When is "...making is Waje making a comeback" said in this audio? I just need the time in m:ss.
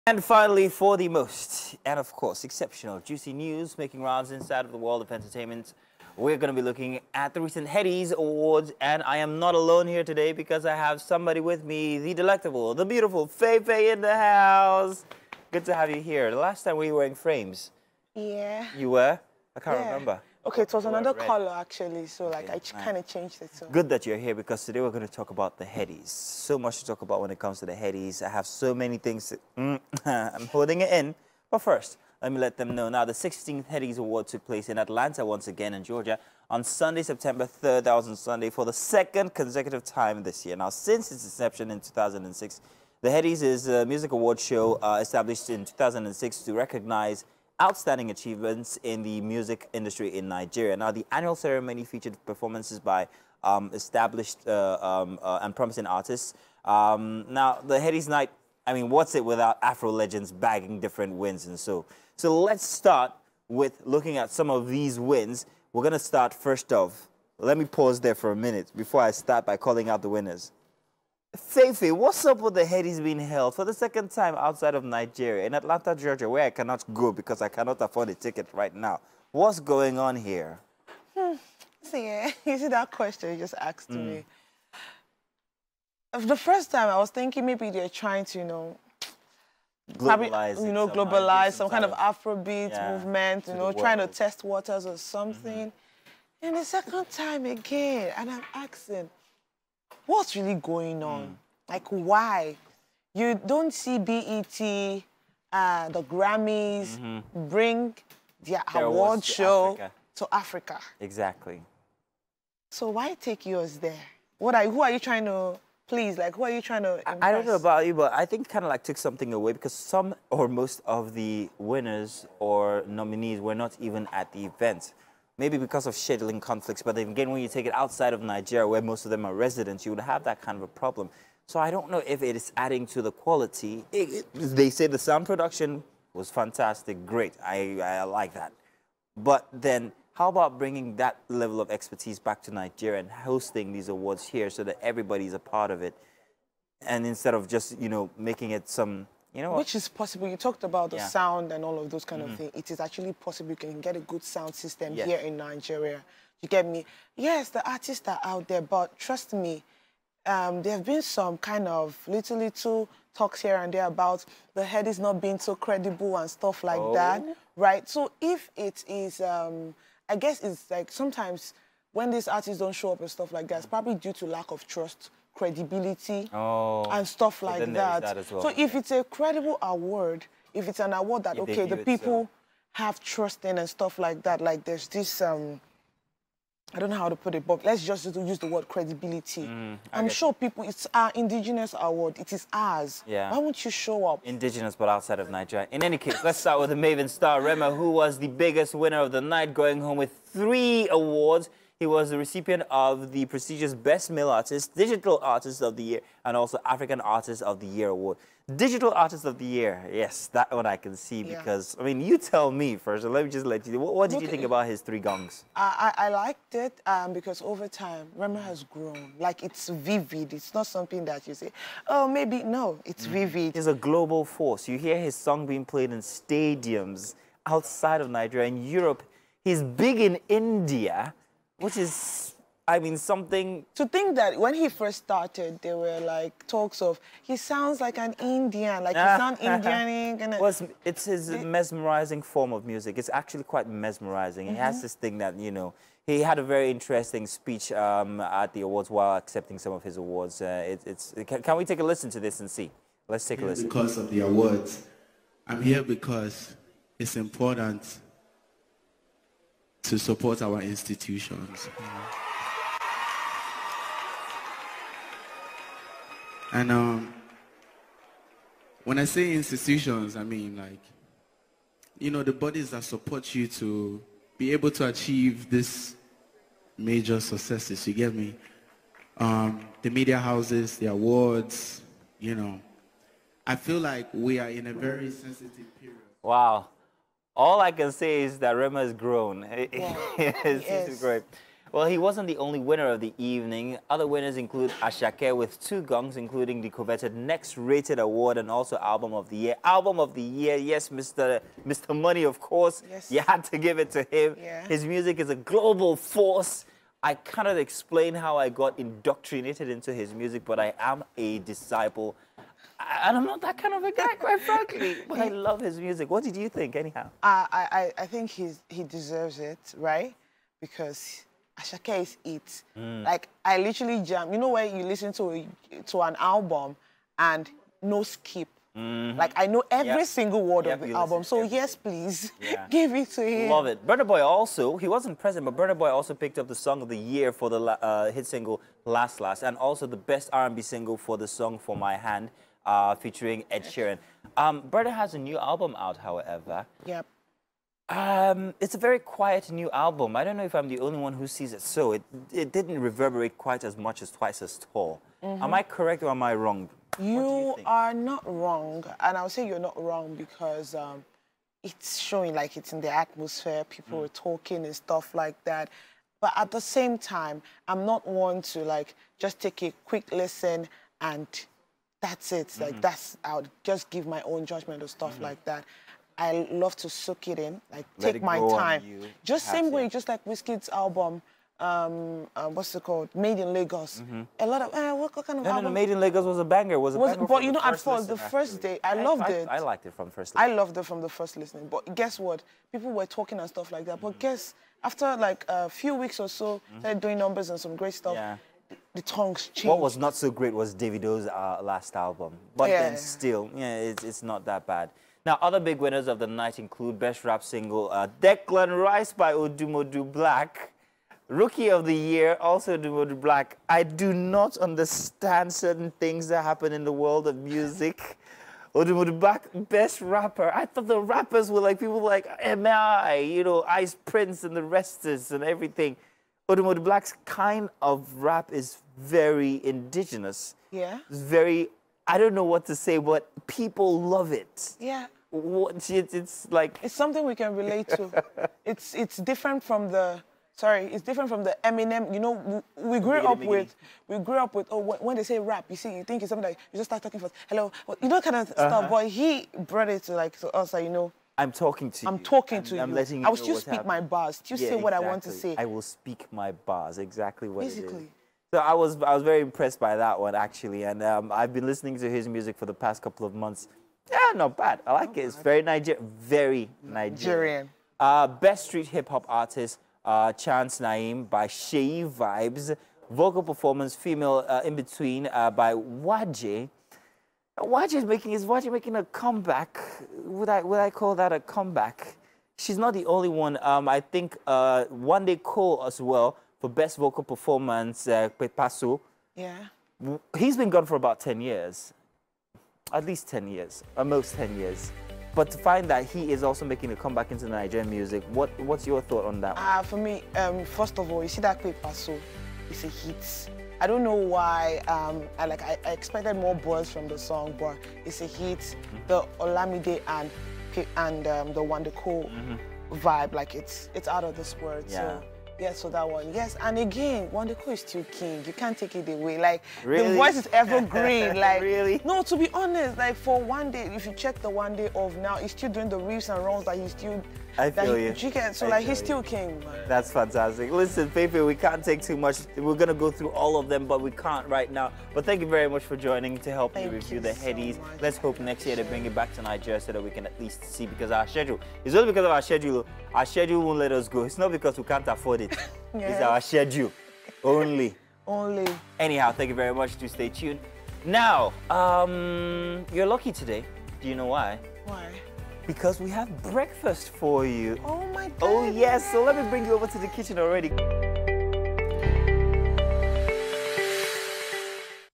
7:58.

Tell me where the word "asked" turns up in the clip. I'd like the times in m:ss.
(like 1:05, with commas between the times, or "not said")
1:23.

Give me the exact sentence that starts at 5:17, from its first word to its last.
Uh, I, I, I think he's, he deserves it, right?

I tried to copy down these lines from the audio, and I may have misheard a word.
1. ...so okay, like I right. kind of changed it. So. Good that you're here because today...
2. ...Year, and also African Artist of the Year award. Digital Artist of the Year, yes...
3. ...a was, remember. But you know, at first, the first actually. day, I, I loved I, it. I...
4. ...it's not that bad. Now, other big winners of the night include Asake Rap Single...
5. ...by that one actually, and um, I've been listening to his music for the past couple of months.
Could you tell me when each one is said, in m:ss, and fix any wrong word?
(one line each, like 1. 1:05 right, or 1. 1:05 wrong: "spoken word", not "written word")
1. 0:22 right
2. 3:25 right
3. 6:26 wrong: "banger", not "remember"
4. 6:44 wrong: "Best", not "Asake"
5. 7:39 right.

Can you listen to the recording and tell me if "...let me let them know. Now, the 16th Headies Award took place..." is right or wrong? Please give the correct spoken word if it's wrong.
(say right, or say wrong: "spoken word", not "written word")
right.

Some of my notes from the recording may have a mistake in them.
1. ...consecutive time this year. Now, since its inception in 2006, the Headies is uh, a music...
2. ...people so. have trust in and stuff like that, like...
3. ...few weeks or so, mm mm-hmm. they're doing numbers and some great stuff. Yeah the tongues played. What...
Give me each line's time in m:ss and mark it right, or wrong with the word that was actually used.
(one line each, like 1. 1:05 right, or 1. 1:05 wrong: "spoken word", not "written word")
1. 0:39 right
2. 3:01 right
3. 6:35 wrong: "changed", not "played".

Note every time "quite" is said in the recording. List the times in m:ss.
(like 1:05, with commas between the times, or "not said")
4:03, 5:14, 5:53.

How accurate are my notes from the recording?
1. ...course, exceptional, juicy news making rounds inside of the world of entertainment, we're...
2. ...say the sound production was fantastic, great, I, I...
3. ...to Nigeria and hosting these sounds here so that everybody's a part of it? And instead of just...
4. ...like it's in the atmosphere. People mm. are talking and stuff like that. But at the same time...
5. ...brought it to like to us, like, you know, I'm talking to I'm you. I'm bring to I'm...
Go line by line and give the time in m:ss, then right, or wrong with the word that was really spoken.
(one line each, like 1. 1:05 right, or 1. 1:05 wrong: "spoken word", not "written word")
1. 0:02 right
2. 2:14 right
3. 2:22 wrong: "awards", not "sounds"
4. 6:02 right
5. 7:29 wrong: "talking", not "bring".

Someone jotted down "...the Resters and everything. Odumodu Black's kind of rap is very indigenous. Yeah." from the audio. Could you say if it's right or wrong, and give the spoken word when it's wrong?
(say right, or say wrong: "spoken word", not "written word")
right.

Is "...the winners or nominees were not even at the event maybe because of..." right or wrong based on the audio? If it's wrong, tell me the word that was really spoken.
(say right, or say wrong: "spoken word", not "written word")
right.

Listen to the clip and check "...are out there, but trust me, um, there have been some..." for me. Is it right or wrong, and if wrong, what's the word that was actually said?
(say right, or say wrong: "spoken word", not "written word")
right.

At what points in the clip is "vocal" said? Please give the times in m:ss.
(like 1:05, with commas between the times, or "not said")
7:53, 8:06.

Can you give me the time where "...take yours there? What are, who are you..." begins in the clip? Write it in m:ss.
1:53.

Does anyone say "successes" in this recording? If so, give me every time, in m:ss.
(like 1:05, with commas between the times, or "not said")
4:37.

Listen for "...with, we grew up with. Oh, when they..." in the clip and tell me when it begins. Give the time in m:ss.
7:23.